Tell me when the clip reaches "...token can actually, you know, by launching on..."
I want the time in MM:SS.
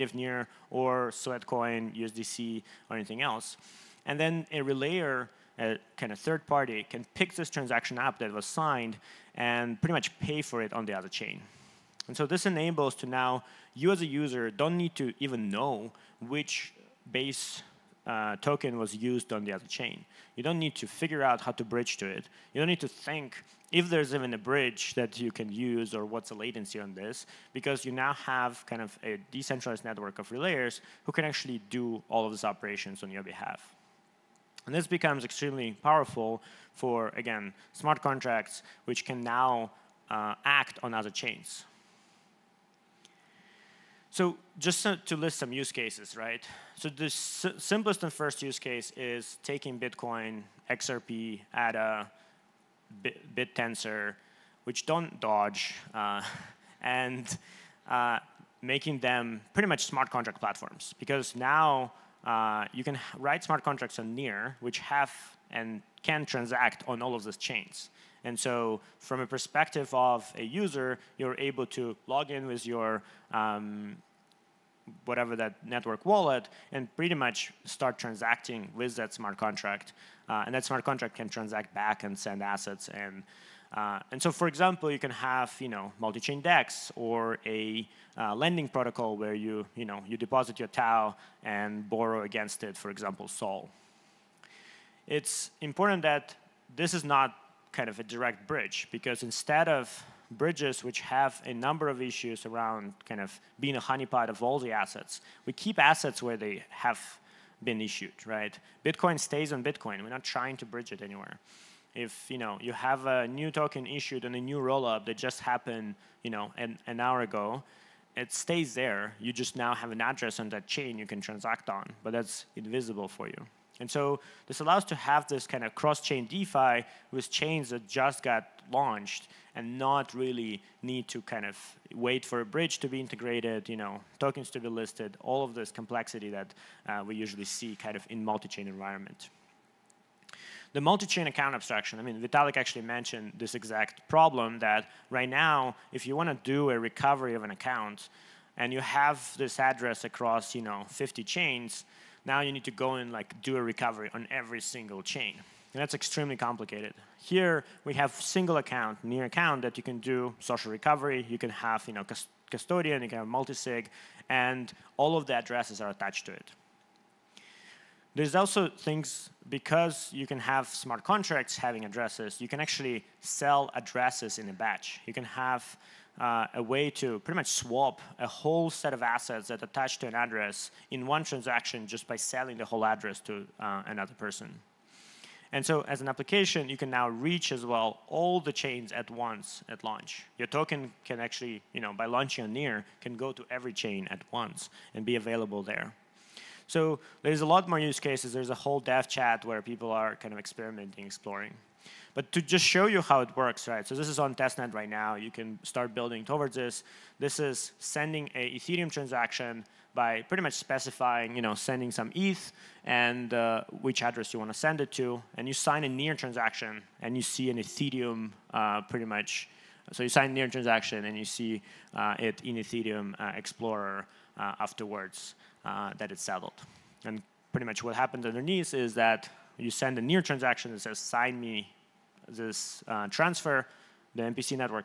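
03:10.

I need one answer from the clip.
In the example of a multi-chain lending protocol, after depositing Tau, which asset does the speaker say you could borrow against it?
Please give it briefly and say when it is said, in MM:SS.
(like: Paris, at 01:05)
Sol, at 01:33.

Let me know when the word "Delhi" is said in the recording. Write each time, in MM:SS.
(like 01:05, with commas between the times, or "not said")
not said.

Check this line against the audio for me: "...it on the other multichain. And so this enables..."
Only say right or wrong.
wrong.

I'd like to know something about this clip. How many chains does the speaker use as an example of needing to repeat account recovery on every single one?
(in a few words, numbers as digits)
50.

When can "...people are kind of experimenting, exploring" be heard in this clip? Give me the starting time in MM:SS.
03:19.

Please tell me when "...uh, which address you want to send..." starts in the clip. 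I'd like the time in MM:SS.
03:33.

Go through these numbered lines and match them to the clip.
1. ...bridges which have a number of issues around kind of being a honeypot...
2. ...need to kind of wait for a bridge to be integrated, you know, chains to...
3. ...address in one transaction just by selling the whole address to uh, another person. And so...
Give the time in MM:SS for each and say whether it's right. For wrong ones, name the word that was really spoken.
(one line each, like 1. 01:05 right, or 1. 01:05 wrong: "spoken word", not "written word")
1. 01:40 right
2. 02:10 wrong: "tokens", not "chains"
3. 03:00 right.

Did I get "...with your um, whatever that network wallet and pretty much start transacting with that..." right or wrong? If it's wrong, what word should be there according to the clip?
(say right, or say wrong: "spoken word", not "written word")
right.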